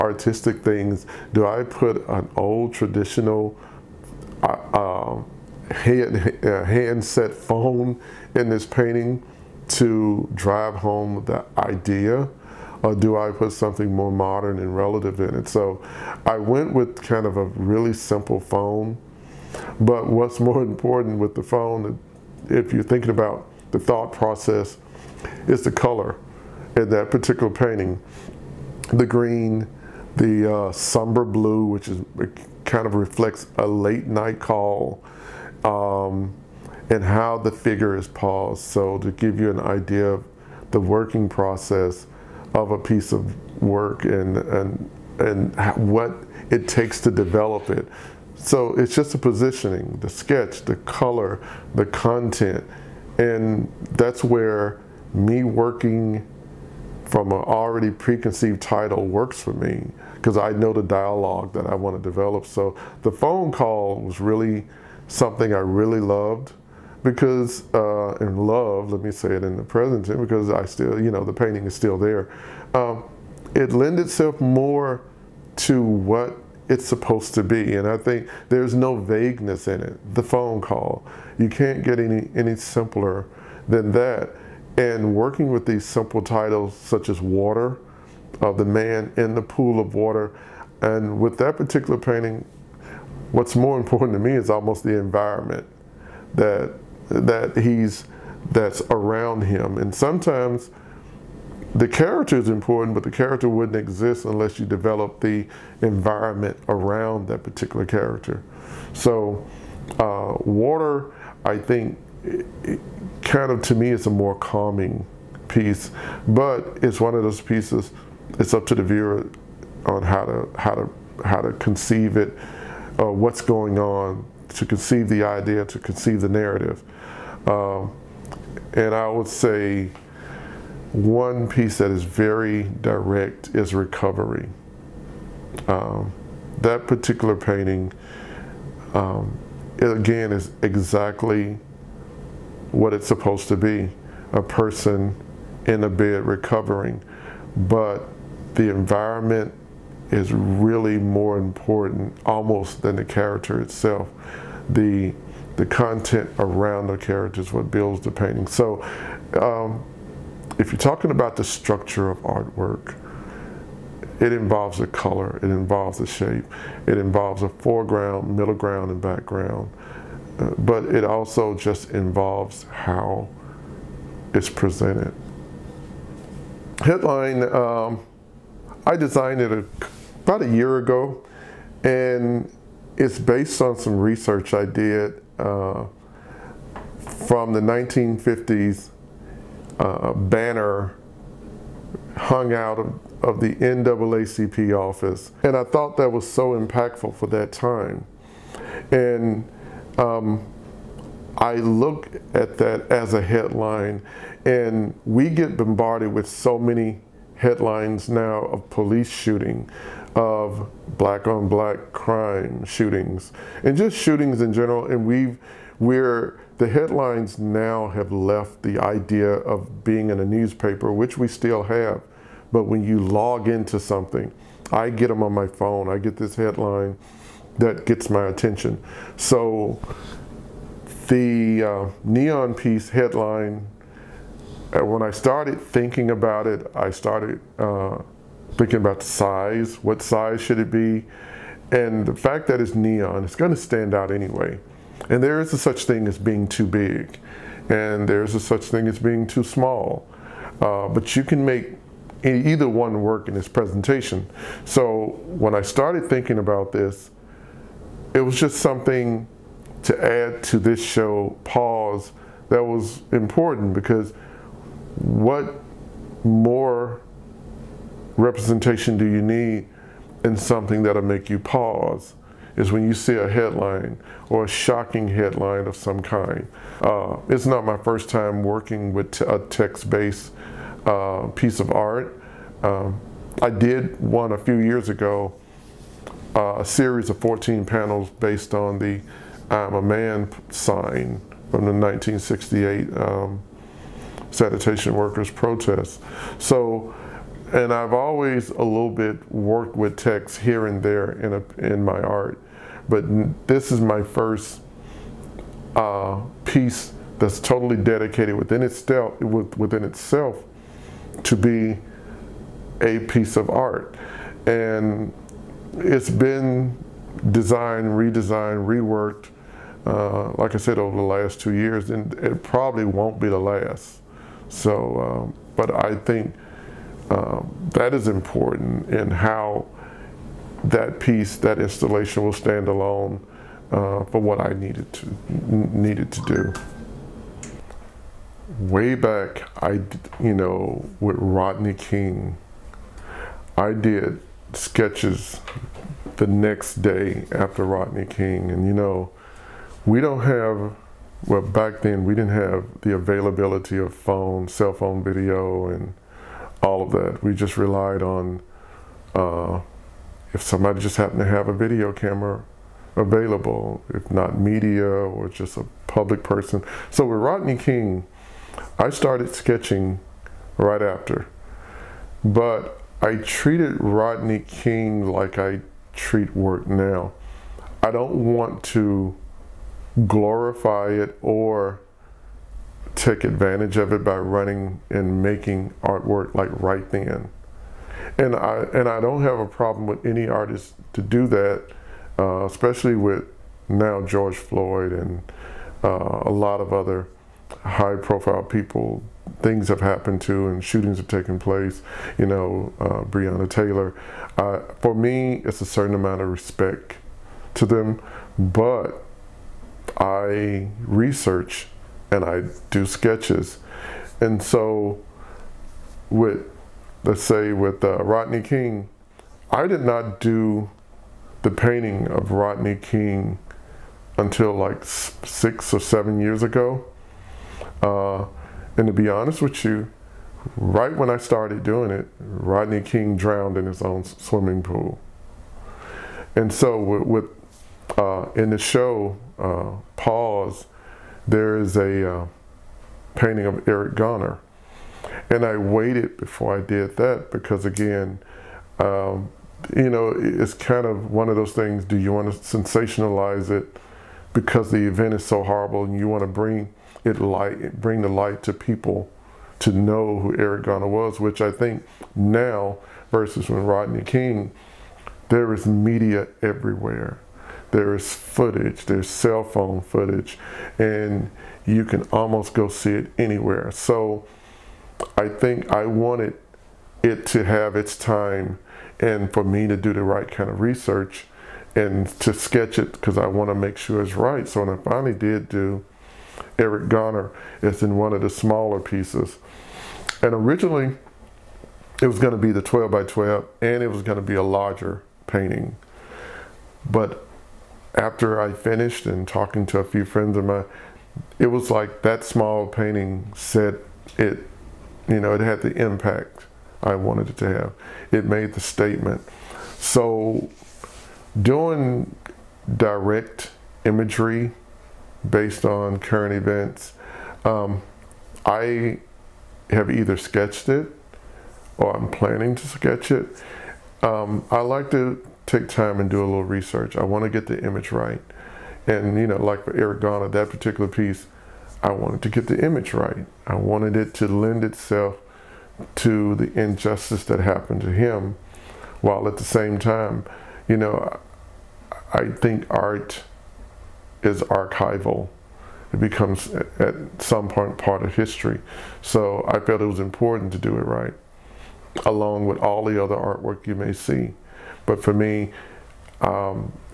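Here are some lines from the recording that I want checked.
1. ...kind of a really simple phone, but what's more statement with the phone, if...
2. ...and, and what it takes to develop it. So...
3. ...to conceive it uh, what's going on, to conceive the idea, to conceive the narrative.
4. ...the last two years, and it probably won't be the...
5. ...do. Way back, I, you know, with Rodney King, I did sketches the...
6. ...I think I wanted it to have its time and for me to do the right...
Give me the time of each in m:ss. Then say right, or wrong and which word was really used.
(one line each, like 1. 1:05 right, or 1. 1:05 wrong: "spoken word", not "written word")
1. 0:17 wrong: "important", not "statement"
2. 0:44 right
3. 2:01 right
4. 5:20 right
5. 5:36 right
6. 7:55 right.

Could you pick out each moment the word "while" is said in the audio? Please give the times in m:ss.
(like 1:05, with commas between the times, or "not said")
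8:59.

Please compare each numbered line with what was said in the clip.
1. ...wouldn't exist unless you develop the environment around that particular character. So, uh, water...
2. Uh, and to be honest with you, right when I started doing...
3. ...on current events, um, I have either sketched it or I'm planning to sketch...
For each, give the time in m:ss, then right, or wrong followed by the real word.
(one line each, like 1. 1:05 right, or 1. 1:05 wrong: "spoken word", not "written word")
1. 1:43 right
2. 7:07 right
3. 8:35 right.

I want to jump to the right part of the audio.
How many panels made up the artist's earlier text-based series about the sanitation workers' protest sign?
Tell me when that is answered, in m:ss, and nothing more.
4:47.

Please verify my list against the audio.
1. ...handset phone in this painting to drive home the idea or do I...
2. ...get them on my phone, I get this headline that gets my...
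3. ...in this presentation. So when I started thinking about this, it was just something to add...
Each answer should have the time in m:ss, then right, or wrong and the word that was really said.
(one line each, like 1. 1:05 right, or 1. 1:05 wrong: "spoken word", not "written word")
1. 0:06 right
2. 3:44 right
3. 4:13 right.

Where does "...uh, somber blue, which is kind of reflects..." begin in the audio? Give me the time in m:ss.
0:30.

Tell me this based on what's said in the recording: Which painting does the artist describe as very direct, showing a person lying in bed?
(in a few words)
Recovery.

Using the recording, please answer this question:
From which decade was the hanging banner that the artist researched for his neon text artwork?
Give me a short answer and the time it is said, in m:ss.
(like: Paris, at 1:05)
1950s, at 3:07.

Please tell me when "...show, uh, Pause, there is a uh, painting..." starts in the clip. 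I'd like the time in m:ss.
7:18.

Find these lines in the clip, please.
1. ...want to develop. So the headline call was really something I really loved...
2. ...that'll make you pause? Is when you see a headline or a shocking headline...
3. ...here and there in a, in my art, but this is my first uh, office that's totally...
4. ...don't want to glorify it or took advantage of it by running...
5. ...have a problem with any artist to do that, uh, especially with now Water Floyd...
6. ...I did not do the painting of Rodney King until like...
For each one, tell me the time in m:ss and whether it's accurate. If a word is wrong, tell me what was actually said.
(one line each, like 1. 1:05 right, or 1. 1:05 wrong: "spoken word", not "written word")
1. 1:01 wrong: "phone", not "headline"
2. 4:30 right
3. 5:00 wrong: "piece", not "office"
4. 6:17 right
5. 6:29 wrong: "George", not "Water"
6. 6:59 right.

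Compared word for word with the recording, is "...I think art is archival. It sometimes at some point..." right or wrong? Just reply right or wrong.
wrong.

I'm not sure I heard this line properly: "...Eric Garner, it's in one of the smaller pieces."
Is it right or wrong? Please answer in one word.
right.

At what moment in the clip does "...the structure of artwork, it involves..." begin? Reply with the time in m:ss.
2:41.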